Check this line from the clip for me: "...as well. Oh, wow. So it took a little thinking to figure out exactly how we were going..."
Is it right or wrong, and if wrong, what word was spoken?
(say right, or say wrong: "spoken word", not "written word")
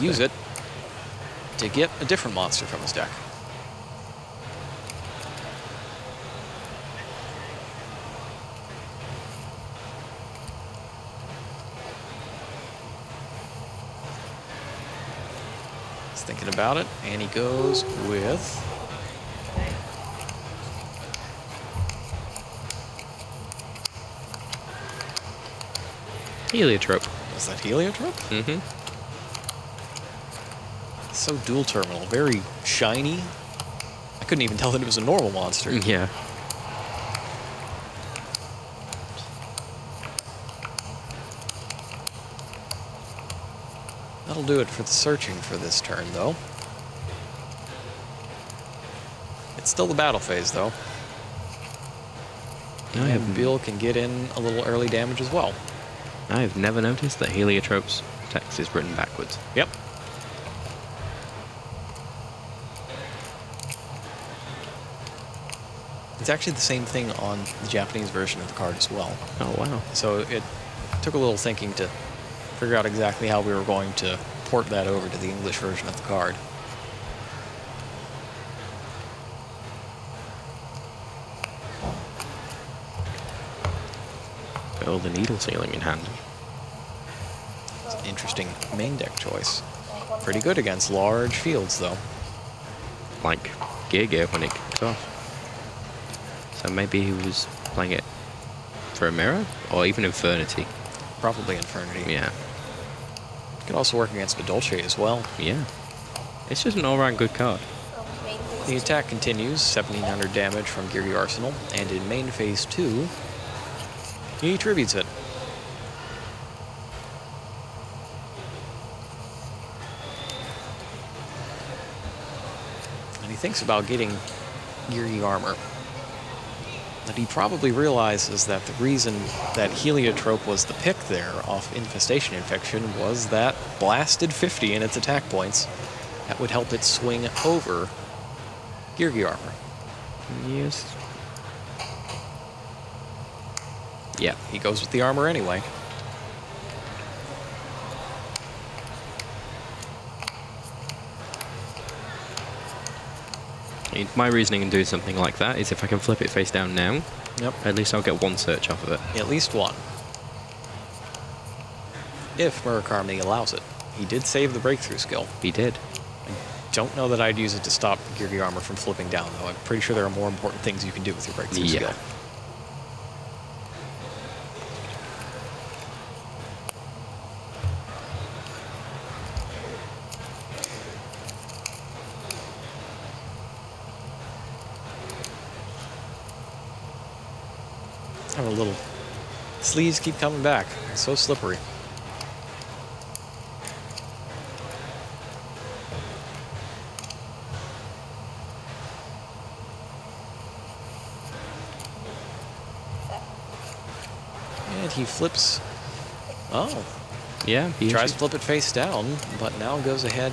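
right.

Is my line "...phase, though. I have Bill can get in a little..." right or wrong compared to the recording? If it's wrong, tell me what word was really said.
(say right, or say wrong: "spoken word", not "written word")
right.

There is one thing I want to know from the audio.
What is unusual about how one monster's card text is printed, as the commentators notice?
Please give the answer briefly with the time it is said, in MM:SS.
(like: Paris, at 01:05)
Backwards, at 00:58.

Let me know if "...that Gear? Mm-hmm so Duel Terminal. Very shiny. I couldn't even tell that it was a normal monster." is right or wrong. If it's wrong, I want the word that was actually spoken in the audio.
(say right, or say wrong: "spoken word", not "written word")
wrong: "Heliotrope", not "Gear".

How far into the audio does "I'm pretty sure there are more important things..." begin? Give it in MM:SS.
02:49.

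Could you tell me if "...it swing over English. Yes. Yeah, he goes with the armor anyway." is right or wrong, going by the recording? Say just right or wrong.
wrong.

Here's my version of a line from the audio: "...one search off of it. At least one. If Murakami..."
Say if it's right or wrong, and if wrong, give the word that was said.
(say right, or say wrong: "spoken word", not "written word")
right.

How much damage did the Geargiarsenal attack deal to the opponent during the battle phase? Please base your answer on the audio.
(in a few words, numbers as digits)
1700.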